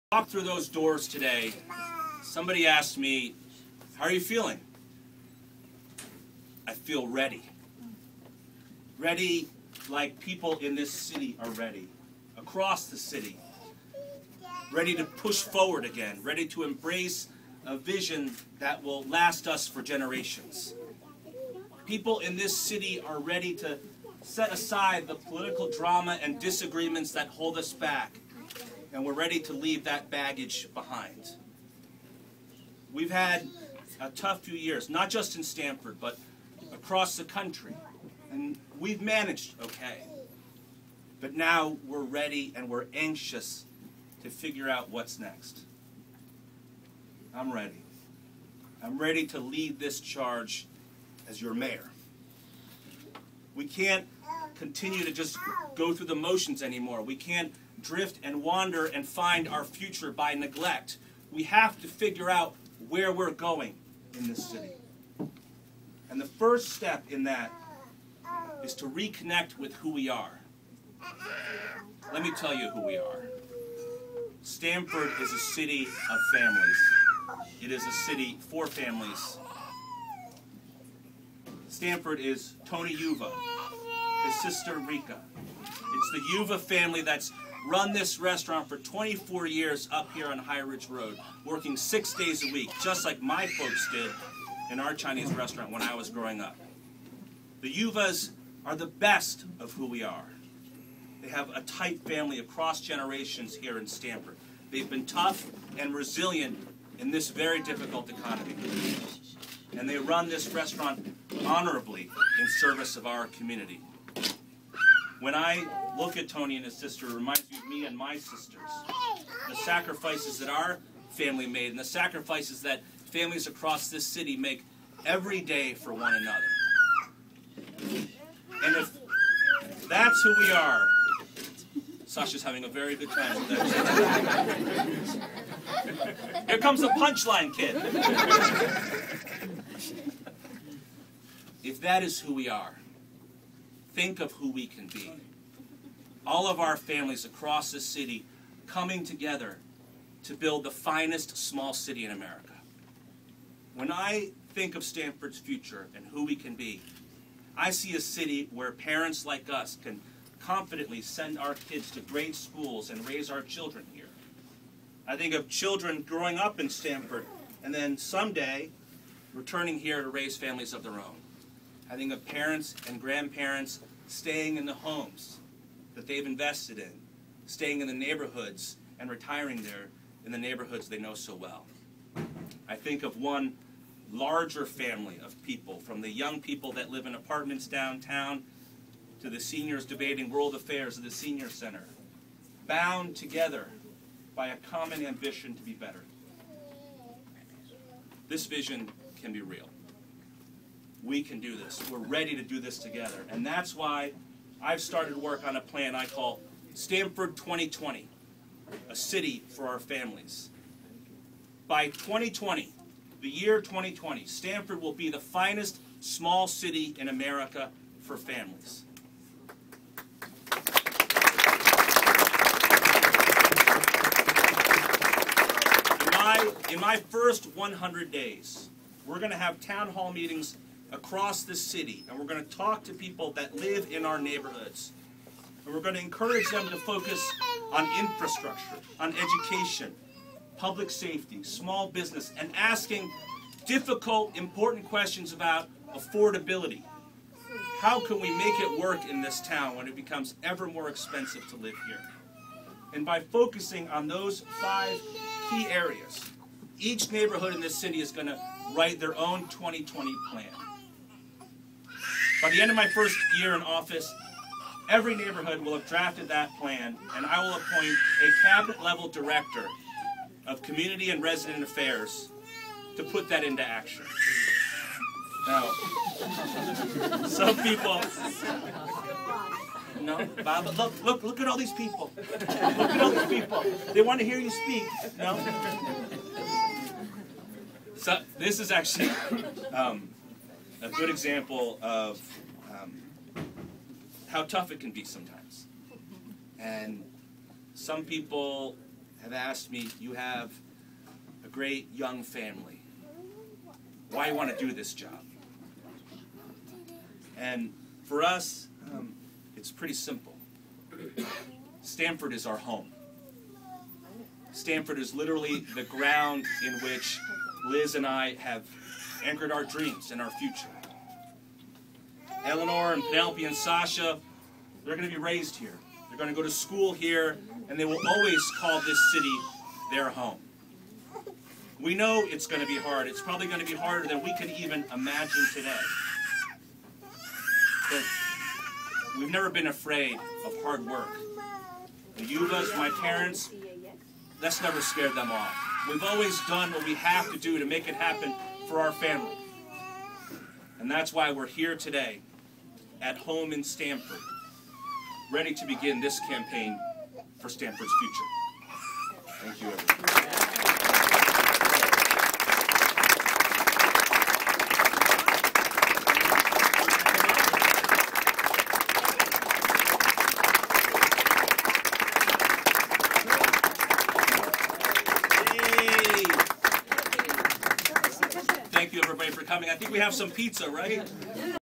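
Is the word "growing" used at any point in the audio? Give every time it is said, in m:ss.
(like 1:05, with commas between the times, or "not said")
1:36, 2:46.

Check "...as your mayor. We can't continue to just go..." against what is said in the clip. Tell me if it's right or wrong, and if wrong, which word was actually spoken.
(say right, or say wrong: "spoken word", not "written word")
right.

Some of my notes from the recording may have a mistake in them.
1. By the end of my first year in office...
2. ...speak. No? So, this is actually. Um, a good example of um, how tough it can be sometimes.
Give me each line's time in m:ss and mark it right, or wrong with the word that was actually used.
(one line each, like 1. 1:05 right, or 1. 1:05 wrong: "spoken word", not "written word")
1. 4:22 right
2. 4:44 right.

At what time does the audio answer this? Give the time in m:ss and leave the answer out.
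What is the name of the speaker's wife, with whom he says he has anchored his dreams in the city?
5:17.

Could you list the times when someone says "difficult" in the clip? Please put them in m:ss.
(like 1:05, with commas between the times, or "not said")
1:47, 4:03.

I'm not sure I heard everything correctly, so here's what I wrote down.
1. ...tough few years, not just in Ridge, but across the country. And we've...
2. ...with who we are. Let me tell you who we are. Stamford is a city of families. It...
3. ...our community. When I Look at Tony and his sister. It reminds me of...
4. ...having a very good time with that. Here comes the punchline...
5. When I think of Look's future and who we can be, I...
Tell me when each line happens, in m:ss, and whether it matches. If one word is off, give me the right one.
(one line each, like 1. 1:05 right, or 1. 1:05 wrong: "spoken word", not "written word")
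1. 0:34 wrong: "Stamford", not "Ridge"
2. 1:09 right
3. 1:53 right
4. 2:12 right
5. 2:33 wrong: "Stamford", not "Look".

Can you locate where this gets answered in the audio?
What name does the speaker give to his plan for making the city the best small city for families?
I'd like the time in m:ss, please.
3:26.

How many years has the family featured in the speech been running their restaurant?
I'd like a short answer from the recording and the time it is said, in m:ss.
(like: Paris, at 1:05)
24, at 1:28.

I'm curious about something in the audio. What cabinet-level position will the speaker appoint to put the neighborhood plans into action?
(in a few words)
Director of community and resident affairs.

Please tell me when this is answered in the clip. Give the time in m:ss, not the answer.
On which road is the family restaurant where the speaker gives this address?
1:30.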